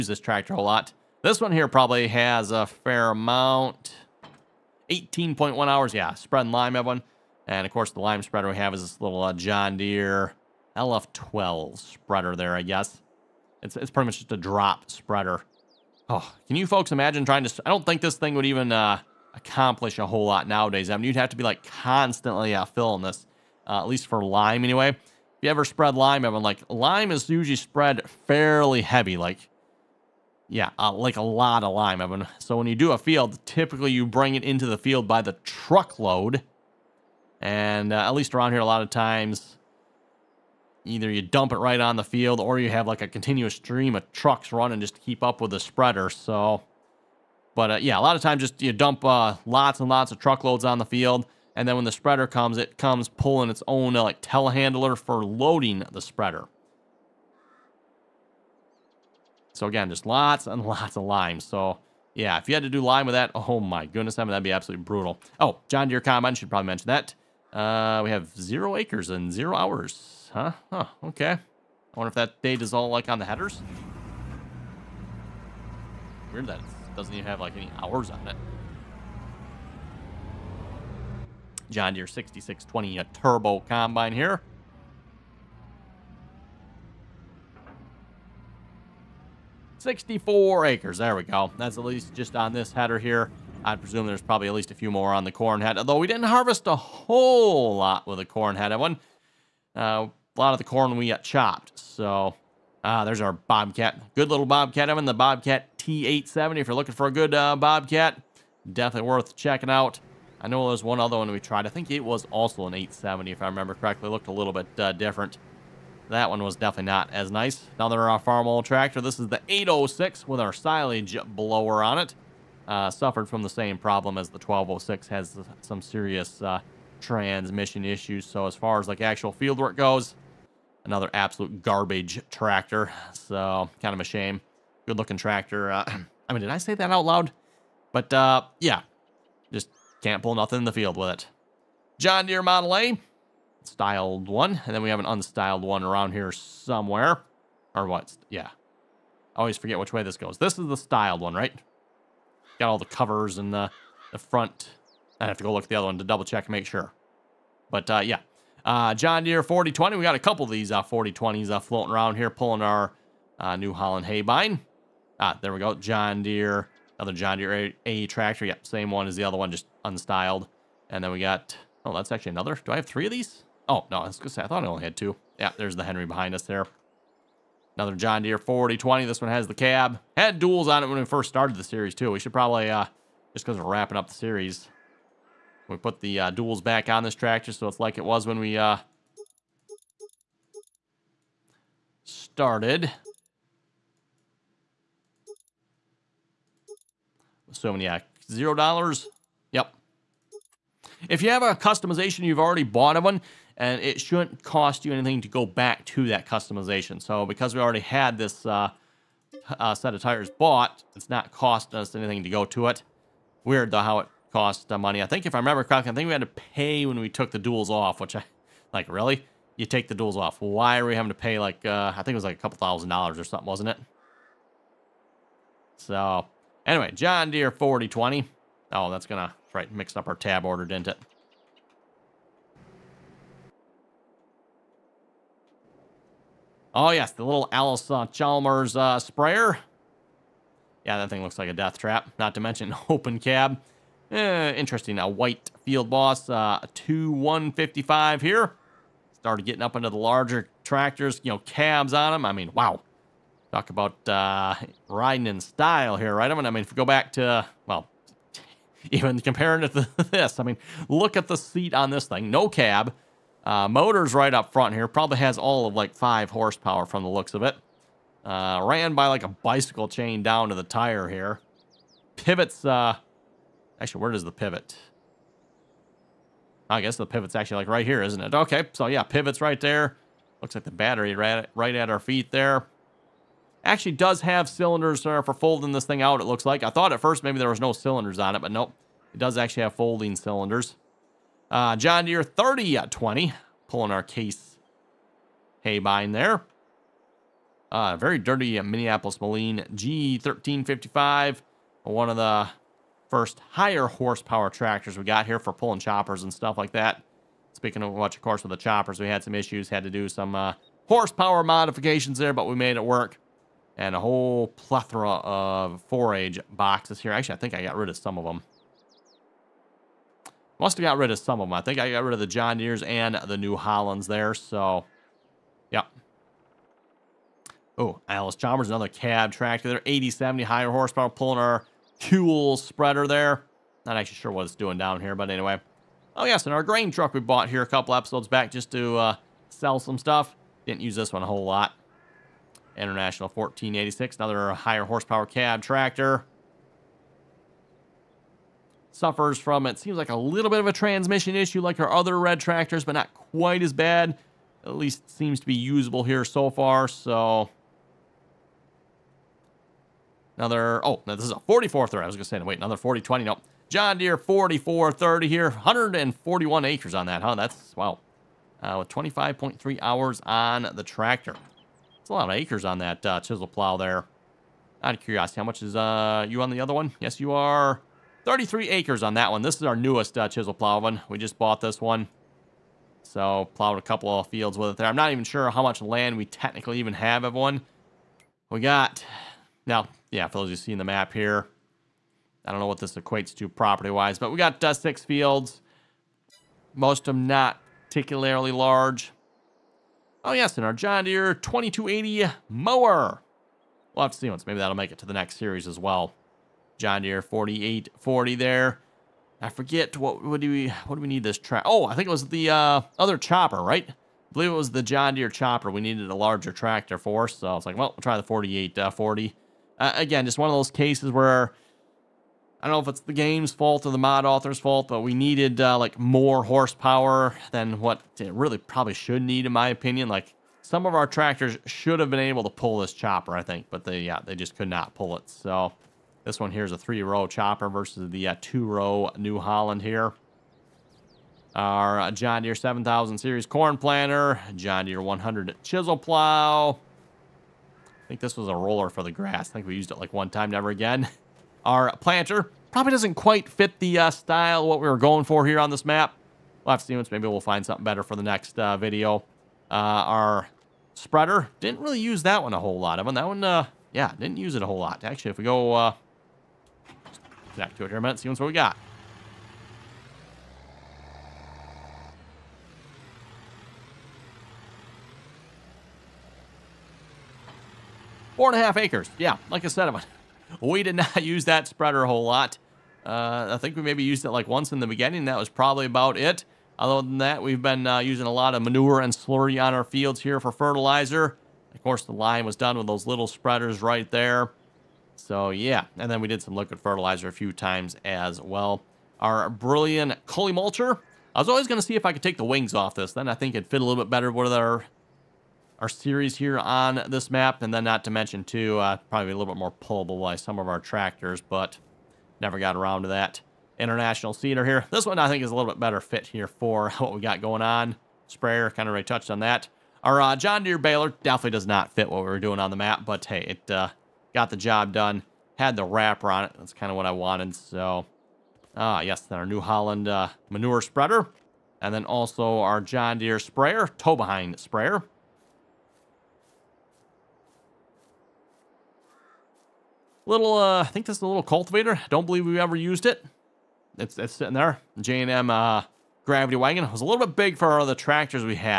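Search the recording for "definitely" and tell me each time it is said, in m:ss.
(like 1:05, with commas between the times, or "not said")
1:48, 1:56, 8:41.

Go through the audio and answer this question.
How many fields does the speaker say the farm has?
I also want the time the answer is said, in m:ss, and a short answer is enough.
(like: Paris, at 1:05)
6, at 6:34.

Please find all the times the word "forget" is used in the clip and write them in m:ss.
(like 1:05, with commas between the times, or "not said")
2:29, 6:49.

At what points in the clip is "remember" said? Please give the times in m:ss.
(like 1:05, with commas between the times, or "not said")
1:53, 3:35.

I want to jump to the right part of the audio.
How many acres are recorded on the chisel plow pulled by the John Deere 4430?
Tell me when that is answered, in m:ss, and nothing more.
6:05.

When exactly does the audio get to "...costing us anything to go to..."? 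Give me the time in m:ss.
3:31.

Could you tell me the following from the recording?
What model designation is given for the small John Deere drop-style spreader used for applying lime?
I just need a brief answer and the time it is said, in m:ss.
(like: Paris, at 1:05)
LF12, at 0:10.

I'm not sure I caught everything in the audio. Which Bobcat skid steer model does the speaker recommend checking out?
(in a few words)
T870.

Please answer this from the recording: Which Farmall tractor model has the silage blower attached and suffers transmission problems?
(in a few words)
806.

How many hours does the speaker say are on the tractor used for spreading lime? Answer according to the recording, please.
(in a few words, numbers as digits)
18.1 hours.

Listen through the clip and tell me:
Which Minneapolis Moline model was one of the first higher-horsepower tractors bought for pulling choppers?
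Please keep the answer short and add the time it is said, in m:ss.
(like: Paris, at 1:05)
G1355, at 4:59.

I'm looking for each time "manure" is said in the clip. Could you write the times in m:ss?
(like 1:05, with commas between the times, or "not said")
8:08, 8:50.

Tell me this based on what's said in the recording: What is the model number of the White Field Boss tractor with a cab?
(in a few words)
2155.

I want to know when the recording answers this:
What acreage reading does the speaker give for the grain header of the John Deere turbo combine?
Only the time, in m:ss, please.
1:29.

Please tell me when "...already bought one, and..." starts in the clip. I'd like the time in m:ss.
3:22.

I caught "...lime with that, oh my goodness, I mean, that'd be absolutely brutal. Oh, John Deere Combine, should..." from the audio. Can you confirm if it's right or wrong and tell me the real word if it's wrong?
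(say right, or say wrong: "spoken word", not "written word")
right.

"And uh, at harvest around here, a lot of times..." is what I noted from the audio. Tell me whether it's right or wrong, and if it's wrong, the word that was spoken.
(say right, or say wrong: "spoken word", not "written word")
wrong: "least", not "harvest".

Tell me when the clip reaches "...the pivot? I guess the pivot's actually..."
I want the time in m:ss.
4:34.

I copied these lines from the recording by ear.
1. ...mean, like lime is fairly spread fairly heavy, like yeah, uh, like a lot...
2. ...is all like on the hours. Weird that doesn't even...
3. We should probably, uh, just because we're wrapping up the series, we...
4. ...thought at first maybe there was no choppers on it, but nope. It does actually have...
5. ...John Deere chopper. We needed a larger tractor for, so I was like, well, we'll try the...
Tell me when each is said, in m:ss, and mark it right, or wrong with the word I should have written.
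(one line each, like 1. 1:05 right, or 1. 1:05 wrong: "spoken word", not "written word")
1. 0:26 wrong: "usually", not "fairly"
2. 1:12 wrong: "headers", not "hours"
3. 3:02 right
4. 4:46 wrong: "cylinders", not "choppers"
5. 6:54 right.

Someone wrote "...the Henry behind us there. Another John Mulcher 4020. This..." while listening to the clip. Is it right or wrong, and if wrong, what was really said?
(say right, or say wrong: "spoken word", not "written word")
wrong: "Deere", not "Mulcher".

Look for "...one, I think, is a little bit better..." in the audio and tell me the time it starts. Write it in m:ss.
8:35.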